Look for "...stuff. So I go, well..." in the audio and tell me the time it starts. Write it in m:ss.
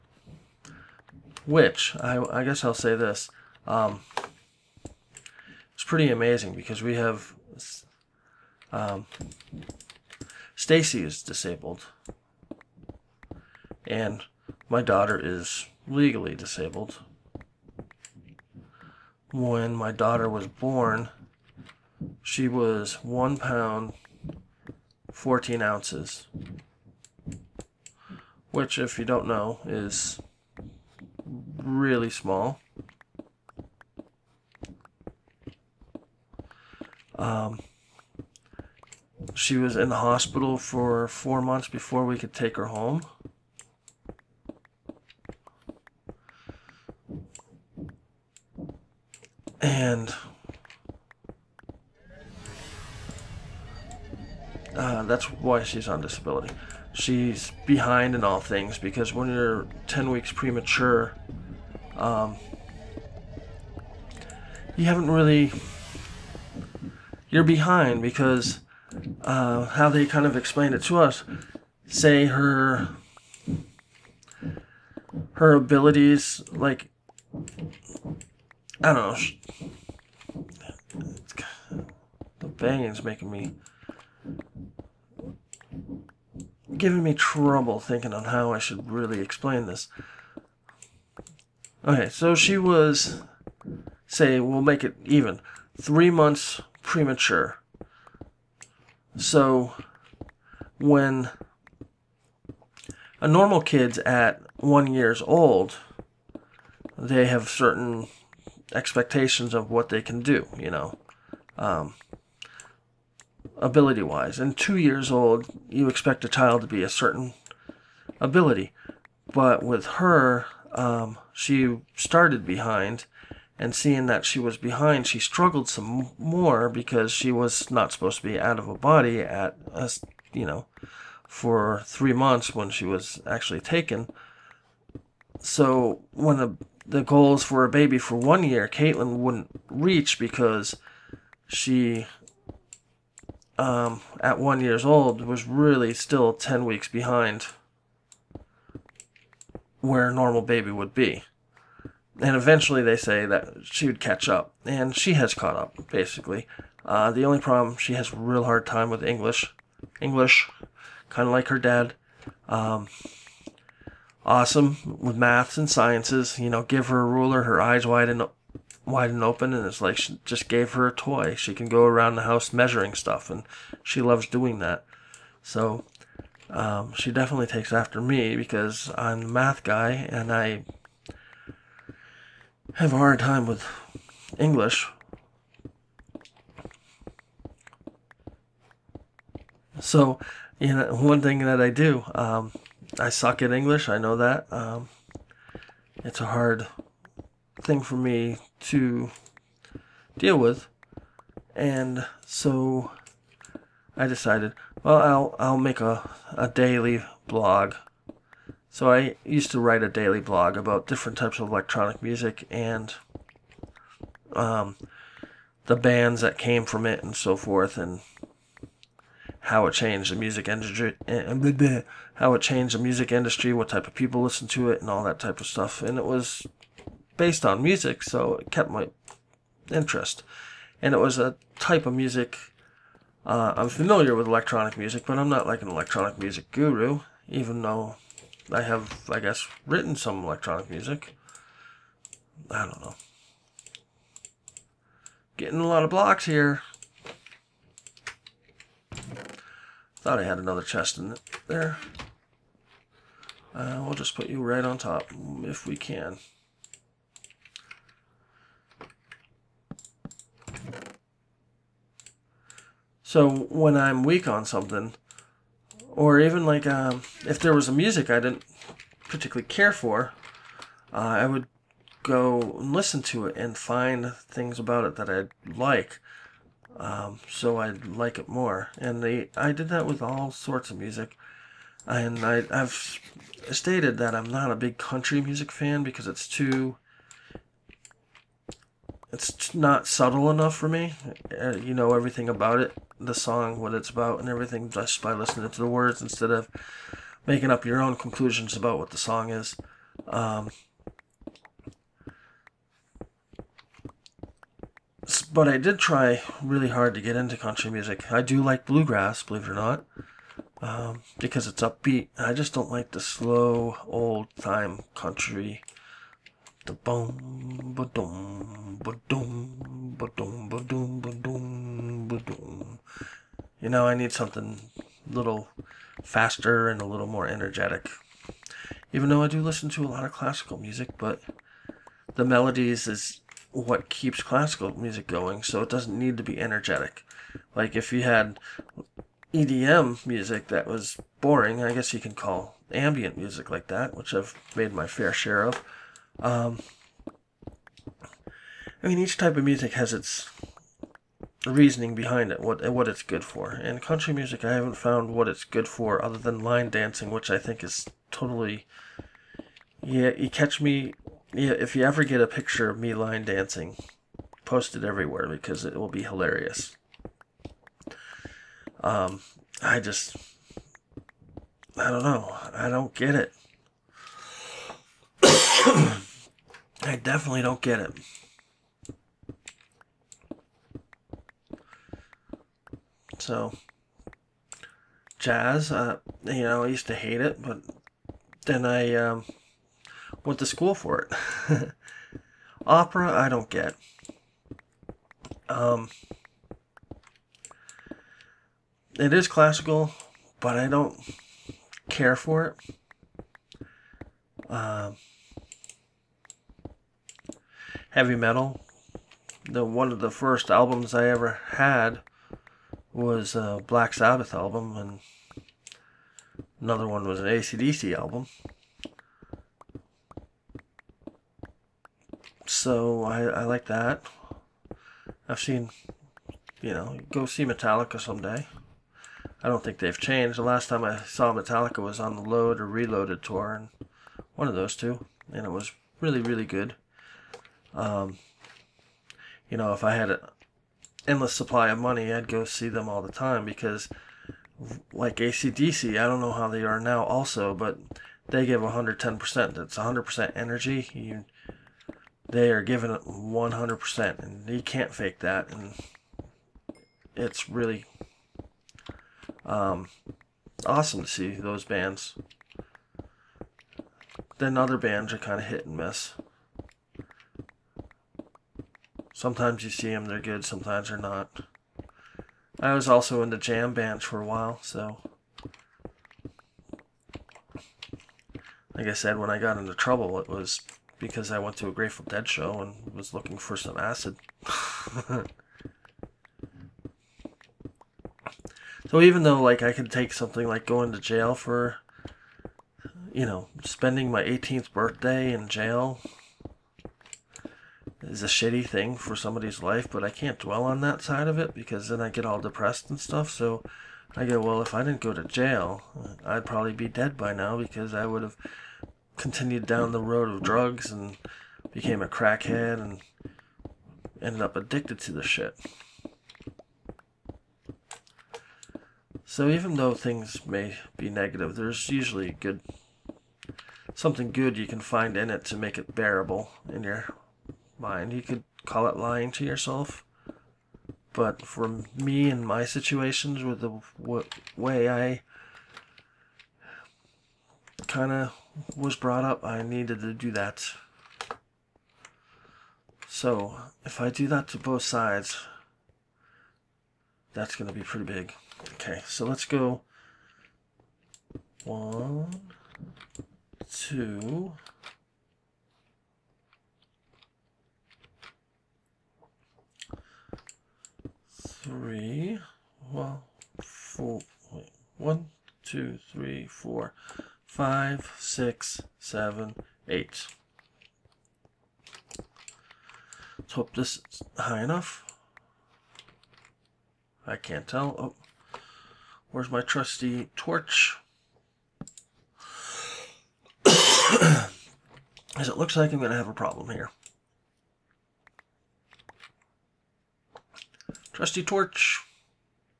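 8:22.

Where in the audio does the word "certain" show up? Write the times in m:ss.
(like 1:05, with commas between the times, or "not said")
1:47, 1:56.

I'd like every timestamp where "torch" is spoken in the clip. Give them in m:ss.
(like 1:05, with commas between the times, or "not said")
9:40, 9:51.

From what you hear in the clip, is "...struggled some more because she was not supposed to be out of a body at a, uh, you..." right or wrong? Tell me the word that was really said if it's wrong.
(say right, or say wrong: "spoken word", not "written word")
right.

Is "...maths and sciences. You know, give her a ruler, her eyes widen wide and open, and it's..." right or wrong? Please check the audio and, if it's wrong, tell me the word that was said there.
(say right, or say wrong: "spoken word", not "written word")
right.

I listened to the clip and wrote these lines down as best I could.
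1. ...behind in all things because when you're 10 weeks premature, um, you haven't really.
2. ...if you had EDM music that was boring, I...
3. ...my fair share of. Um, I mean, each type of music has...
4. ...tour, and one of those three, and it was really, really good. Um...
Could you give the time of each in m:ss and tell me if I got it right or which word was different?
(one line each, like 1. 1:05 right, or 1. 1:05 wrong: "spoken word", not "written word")
1. 0:57 right
2. 5:37 right
3. 5:44 right
4. 7:13 wrong: "two", not "three".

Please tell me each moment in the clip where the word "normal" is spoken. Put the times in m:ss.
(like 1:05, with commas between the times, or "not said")
1:43, 2:30.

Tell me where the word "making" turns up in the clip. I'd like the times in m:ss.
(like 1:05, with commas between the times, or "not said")
1:23, 4:57.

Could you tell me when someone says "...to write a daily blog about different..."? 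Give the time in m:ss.
3:29.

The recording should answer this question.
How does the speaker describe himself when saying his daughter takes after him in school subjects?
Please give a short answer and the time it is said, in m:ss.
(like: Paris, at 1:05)
The math guy, at 2:59.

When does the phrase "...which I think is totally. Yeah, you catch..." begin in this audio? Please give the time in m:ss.
5:57.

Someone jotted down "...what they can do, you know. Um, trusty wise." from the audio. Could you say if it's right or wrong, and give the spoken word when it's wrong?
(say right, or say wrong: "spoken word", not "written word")
wrong: "ability", not "trusty".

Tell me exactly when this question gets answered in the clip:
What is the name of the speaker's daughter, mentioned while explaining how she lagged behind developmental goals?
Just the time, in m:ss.
2:18.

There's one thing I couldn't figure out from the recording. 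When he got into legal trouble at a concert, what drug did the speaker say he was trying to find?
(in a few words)
Acid.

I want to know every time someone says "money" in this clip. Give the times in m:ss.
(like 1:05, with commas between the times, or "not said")
7:21.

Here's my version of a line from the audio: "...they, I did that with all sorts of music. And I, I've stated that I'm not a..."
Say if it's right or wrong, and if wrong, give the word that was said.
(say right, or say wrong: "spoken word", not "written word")
right.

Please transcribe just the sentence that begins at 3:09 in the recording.
So, you know, one thing that I do, um, I suck at English.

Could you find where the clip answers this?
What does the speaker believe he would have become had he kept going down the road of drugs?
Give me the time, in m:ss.
8:32.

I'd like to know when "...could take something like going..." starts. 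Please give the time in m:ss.
8:09.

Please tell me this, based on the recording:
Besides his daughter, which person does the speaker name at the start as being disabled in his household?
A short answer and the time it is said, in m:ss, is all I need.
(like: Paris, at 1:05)
Stacy, at 0:10.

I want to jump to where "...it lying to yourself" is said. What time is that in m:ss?
8:48.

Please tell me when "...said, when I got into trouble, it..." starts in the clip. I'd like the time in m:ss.
7:58.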